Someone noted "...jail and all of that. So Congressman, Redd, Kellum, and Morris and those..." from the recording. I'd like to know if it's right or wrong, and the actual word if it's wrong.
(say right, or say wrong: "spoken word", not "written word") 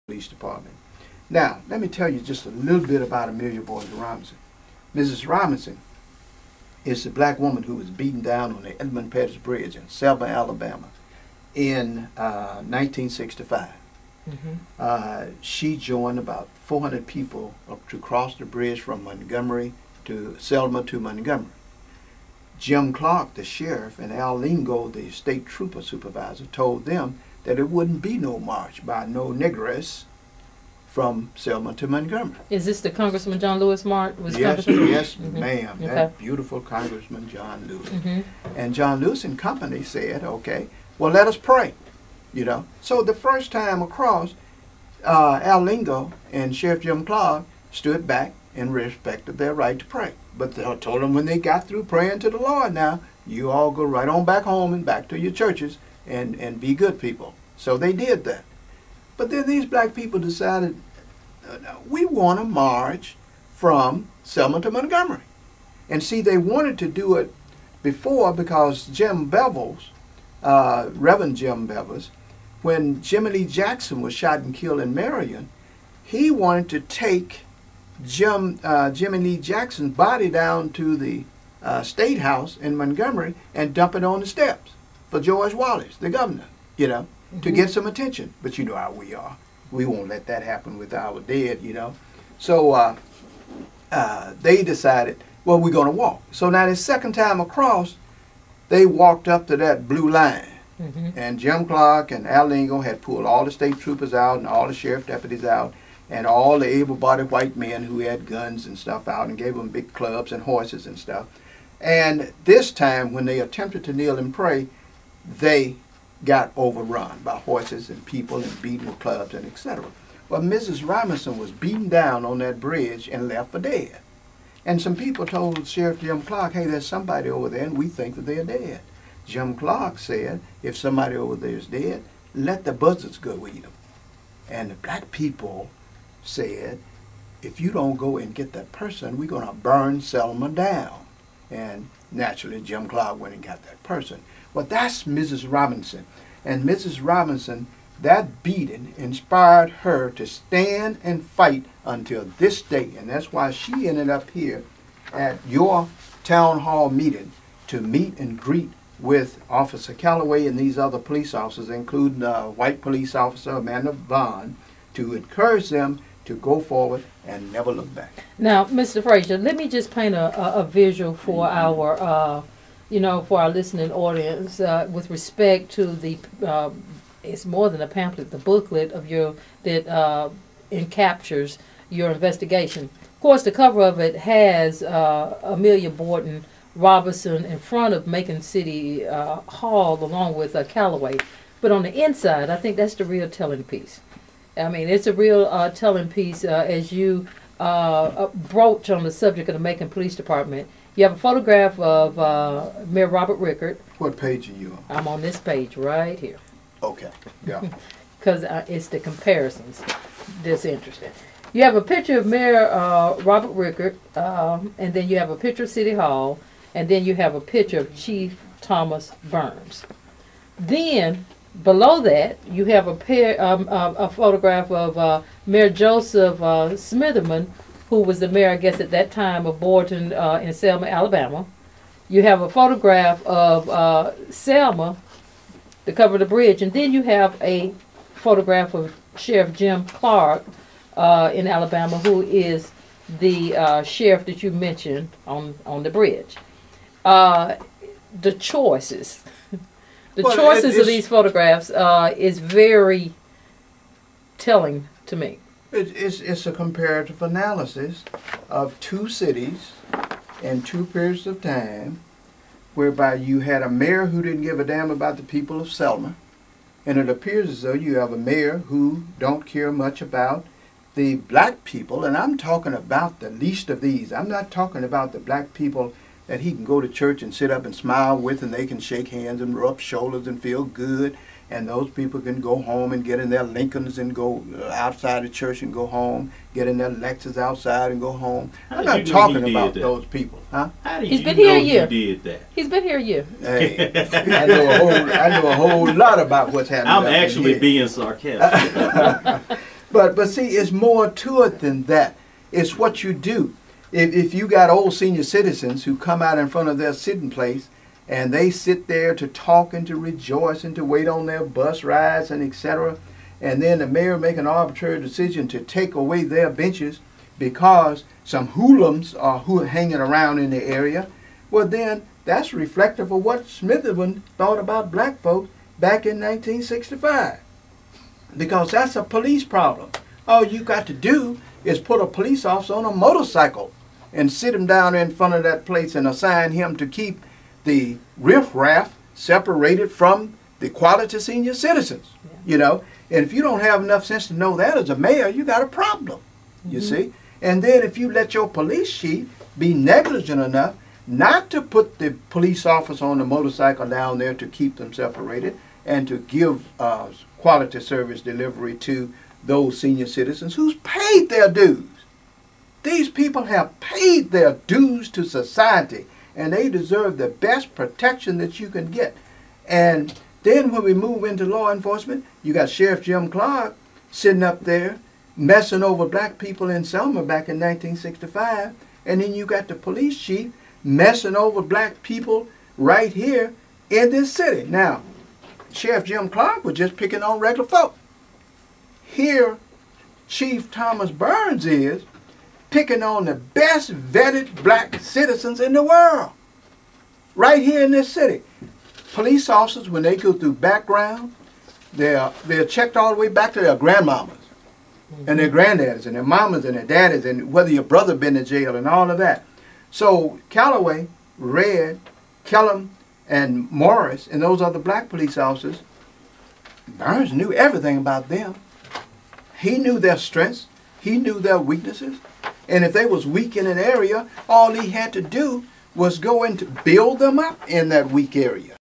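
wrong: "Calloway", not "Congressman".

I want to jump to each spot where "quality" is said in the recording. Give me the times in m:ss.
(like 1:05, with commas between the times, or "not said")
5:40, 5:57.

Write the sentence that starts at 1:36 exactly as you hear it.
So now the second time across, they walked up to that blue line.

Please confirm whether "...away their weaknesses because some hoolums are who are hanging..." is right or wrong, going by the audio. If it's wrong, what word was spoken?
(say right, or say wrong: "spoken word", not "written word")
wrong: "benches", not "weaknesses".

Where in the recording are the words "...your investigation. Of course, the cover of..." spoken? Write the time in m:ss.
3:01.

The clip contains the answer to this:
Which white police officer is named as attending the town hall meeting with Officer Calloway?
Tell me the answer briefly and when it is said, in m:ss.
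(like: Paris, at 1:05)
Amanda Vaughn, at 2:43.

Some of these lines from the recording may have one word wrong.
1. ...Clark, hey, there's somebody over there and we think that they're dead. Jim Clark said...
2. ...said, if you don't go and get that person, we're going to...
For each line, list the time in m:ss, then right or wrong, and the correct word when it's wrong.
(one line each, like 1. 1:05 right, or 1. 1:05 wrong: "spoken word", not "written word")
1. 2:06 right
2. 2:16 right.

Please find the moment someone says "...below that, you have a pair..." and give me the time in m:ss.
3:41.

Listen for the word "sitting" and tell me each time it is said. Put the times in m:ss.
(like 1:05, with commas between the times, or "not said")
5:06, 6:14.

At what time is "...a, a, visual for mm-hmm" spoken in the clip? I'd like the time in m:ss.
2:50.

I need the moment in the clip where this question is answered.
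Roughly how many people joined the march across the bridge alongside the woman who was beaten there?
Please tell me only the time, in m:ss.
0:16.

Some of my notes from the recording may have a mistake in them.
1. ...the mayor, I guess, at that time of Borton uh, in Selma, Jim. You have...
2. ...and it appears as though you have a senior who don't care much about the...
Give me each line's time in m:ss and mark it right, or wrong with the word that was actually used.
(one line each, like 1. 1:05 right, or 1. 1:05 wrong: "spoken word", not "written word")
1. 3:48 wrong: "Alabama", not "Jim"
2. 4:26 wrong: "mayor", not "senior".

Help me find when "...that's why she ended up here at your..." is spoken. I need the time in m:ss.
2:33.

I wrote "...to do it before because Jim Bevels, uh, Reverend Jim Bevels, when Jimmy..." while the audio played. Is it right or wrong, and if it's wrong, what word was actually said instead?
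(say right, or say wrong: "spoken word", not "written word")
right.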